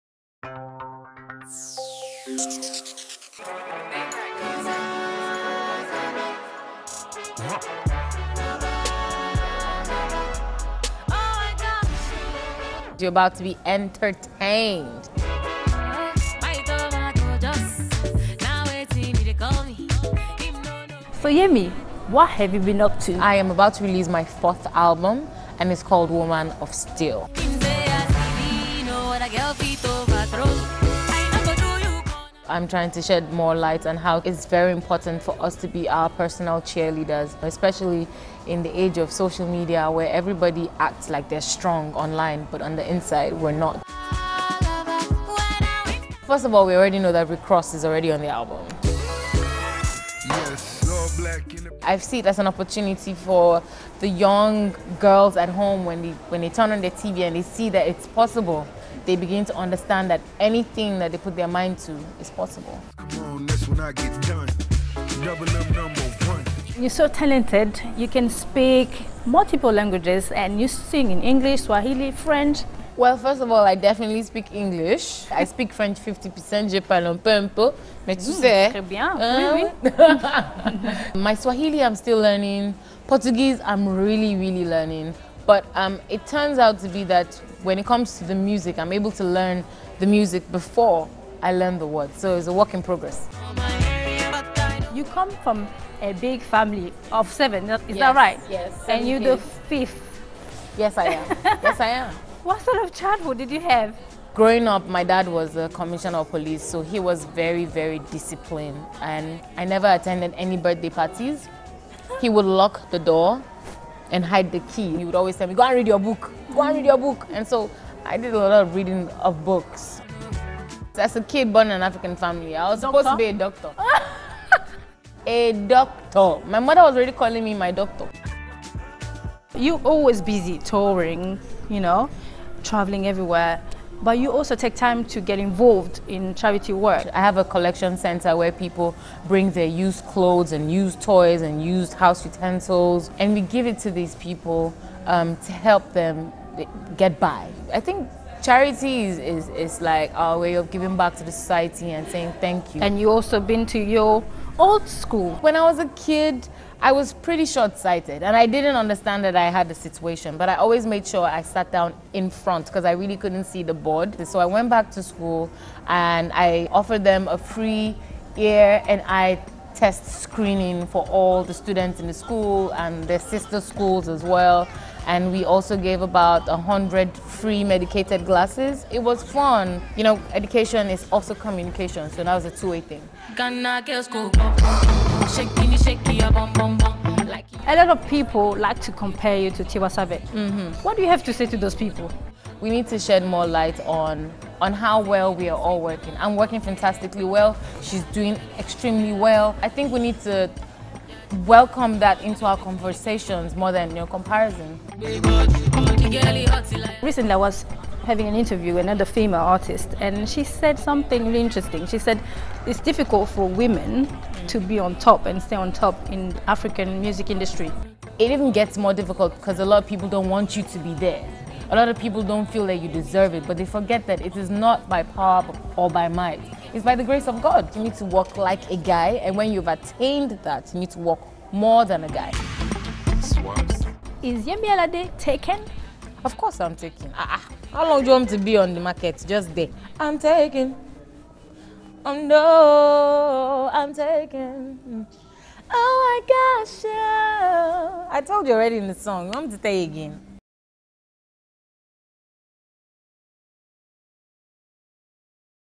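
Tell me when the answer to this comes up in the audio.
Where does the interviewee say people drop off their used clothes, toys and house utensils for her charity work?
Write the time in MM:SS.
02:17.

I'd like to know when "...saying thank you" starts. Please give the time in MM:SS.
02:32.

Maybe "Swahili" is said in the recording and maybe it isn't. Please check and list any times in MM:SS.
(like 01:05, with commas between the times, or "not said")
01:11, 01:21.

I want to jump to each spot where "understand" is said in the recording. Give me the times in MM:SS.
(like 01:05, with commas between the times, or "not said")
00:59, 02:38.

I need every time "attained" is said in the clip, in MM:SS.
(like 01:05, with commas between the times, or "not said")
03:49.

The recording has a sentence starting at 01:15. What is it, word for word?
I speak French 50%, je parle un peu, un peu.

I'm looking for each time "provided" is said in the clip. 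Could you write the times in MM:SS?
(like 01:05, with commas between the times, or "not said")
not said.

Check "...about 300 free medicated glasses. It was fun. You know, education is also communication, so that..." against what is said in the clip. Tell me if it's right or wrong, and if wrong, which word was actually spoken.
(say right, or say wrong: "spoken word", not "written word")
wrong: "100", not "300".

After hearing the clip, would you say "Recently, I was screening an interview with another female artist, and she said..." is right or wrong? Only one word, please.
wrong.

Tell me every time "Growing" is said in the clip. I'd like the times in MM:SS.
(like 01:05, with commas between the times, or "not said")
01:44.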